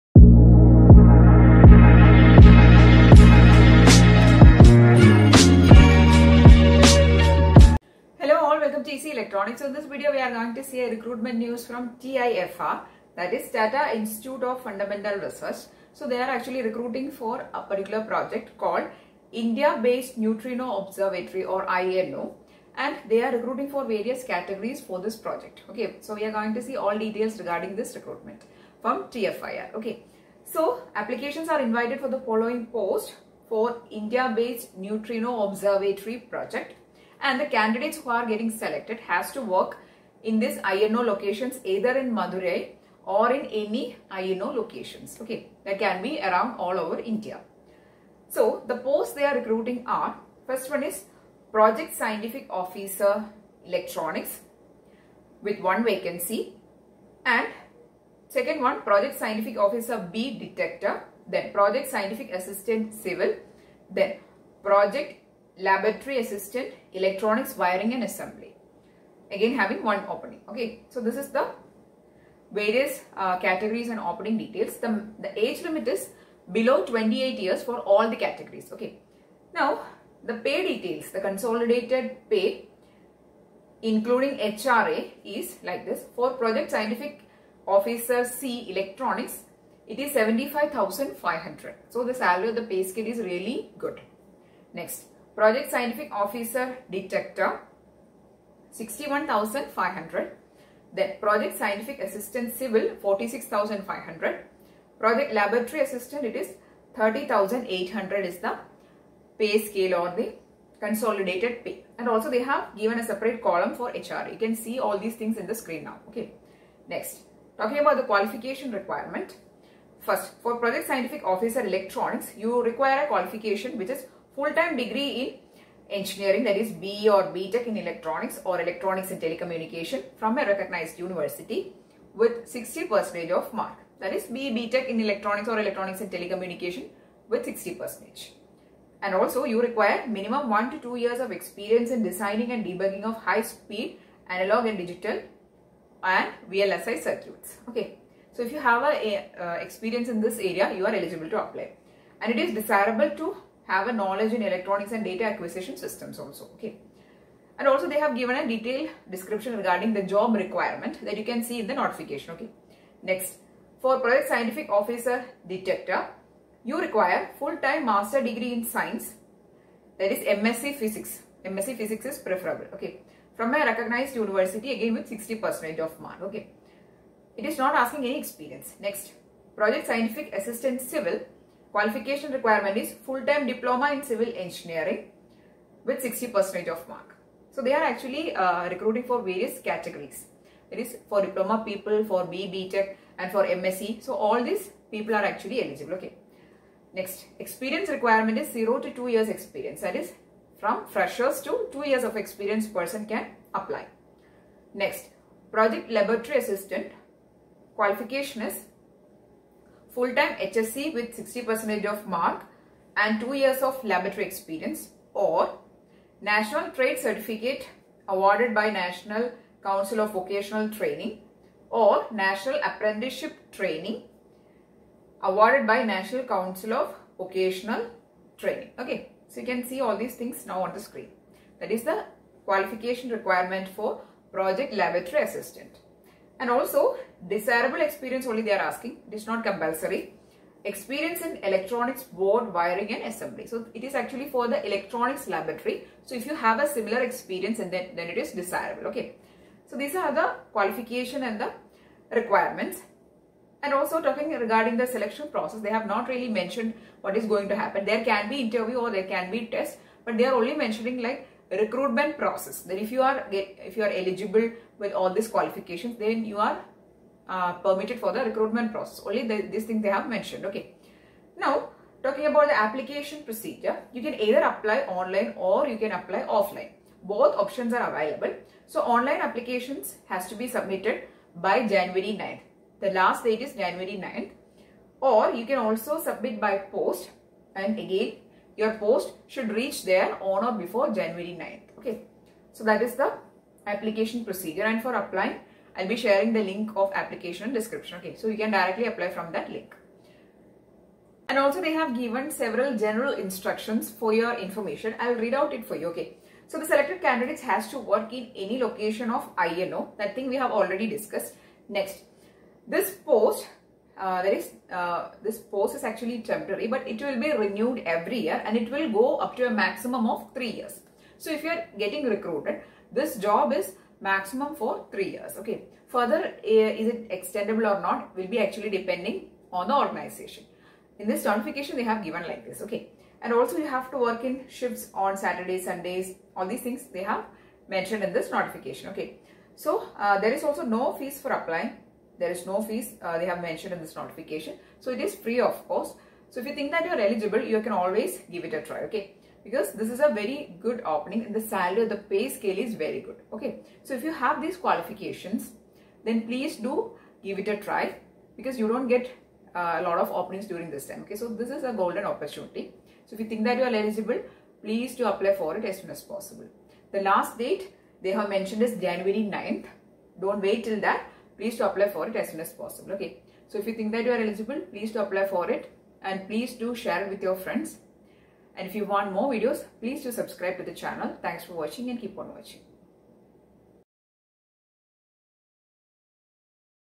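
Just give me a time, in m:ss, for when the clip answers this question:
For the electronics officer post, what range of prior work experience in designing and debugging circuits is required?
2:20.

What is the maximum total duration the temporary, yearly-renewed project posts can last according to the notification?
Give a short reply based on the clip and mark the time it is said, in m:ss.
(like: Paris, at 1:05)
3 years, at 5:20.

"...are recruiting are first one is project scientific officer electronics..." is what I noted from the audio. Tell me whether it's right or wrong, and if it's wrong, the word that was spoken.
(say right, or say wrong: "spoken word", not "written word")
right.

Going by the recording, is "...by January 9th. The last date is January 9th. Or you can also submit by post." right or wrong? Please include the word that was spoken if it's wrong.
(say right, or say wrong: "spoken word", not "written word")
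right.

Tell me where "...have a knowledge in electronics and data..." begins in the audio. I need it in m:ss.
2:33.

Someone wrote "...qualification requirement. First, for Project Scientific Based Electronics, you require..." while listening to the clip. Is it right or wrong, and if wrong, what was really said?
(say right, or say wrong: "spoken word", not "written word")
wrong: "Officer", not "Based".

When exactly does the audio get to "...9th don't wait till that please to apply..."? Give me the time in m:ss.
6:09.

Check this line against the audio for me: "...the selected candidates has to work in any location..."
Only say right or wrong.
right.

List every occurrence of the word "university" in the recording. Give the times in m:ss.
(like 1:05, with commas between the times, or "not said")
2:10, 2:54.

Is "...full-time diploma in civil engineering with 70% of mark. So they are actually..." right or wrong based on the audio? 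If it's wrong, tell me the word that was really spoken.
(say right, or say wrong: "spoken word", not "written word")
wrong: "60", not "70".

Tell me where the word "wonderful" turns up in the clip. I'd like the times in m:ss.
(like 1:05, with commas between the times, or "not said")
not said.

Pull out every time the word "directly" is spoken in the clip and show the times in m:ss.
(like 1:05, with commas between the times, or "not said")
4:58.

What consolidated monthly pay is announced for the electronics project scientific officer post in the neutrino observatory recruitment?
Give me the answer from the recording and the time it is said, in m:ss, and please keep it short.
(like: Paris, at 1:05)
75,500, at 1:30.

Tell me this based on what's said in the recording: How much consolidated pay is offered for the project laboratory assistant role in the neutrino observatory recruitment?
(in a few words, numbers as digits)
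30,800.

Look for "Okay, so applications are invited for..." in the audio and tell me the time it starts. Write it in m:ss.
0:29.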